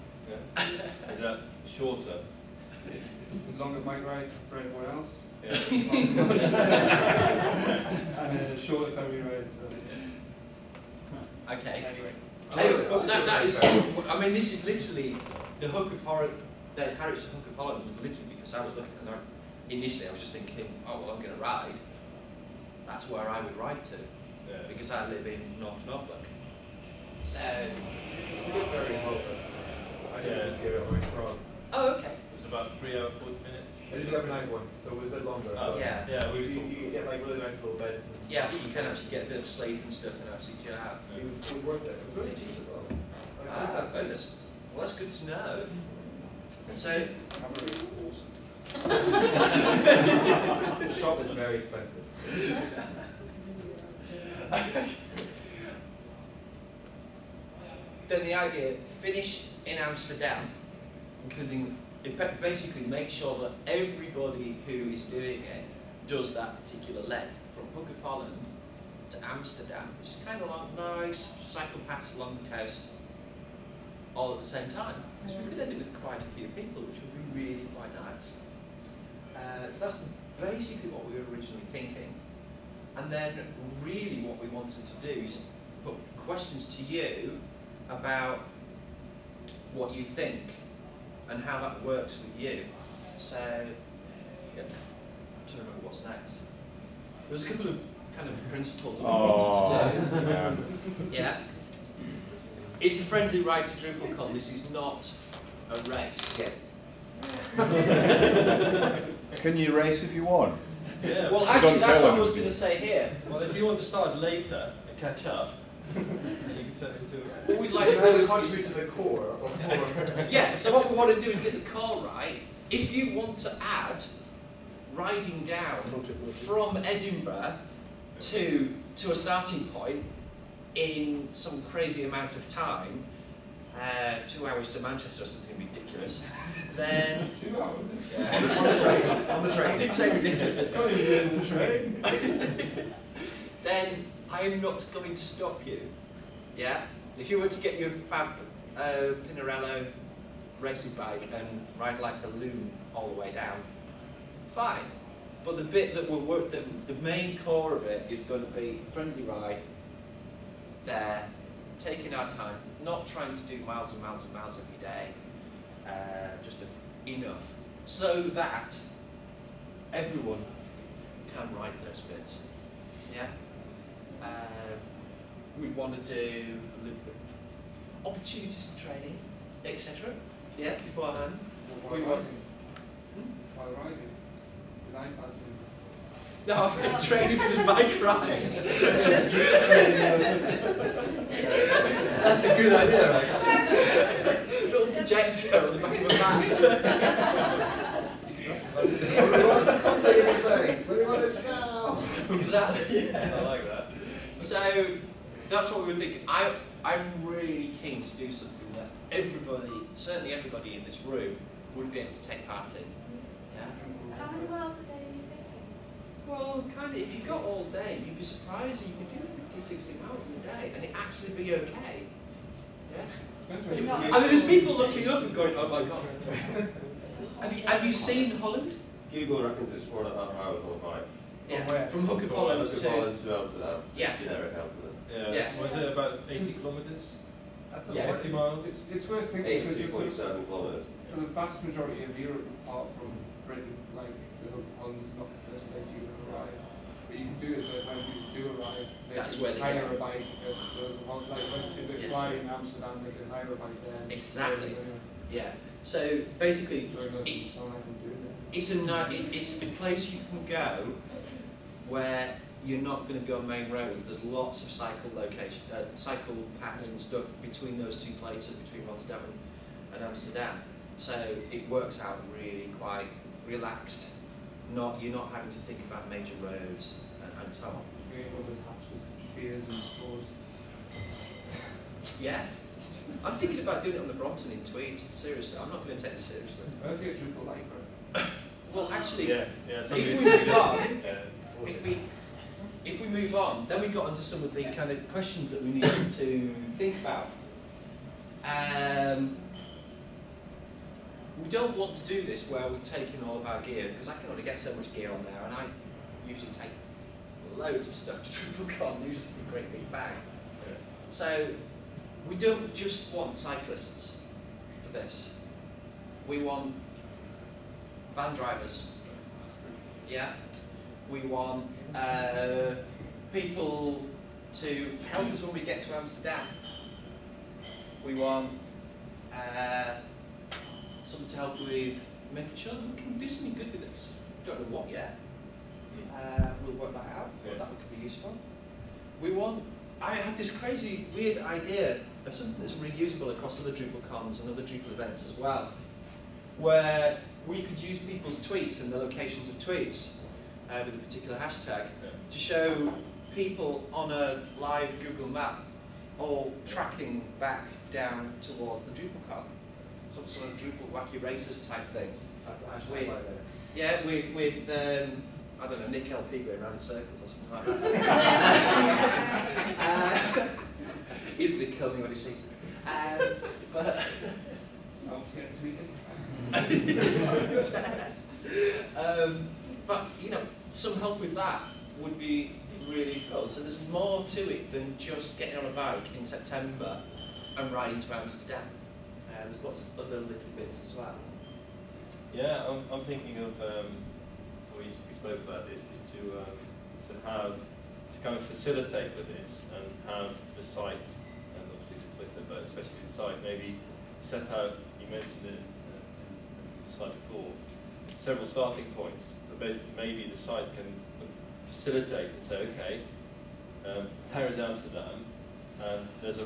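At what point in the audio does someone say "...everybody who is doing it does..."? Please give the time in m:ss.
1:03.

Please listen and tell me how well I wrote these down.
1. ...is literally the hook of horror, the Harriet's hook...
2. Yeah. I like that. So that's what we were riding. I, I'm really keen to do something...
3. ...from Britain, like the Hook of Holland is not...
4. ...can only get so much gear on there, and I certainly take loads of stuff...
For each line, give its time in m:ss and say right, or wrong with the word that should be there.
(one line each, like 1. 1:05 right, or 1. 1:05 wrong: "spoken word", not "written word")
1. 0:14 right
2. 3:23 wrong: "thinking", not "riding"
3. 4:02 right
4. 5:04 wrong: "usually", not "certainly".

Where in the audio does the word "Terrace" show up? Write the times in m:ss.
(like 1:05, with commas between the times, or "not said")
6:54.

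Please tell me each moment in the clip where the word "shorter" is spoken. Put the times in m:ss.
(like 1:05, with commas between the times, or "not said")
0:01, 0:08.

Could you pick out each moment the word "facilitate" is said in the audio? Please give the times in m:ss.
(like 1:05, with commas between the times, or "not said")
6:38, 6:51.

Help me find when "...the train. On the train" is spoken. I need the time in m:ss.
2:18.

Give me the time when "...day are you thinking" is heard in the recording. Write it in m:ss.
3:34.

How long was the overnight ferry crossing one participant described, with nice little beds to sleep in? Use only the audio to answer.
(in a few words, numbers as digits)
3 hours 40 minutes.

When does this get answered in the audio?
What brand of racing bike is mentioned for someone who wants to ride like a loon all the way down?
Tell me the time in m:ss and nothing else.
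2:29.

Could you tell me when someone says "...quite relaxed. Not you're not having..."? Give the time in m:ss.
4:32.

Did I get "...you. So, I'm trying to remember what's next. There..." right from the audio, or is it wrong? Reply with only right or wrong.
right.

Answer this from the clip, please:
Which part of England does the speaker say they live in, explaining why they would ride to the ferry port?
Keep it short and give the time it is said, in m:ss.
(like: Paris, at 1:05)
North Norfolk, at 0:25.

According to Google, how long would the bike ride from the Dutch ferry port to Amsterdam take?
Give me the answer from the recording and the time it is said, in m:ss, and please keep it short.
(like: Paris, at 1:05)
4.5 hours, at 3:49.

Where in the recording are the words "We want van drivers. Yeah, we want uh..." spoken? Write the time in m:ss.
5:16.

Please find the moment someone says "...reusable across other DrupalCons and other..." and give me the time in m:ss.
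5:42.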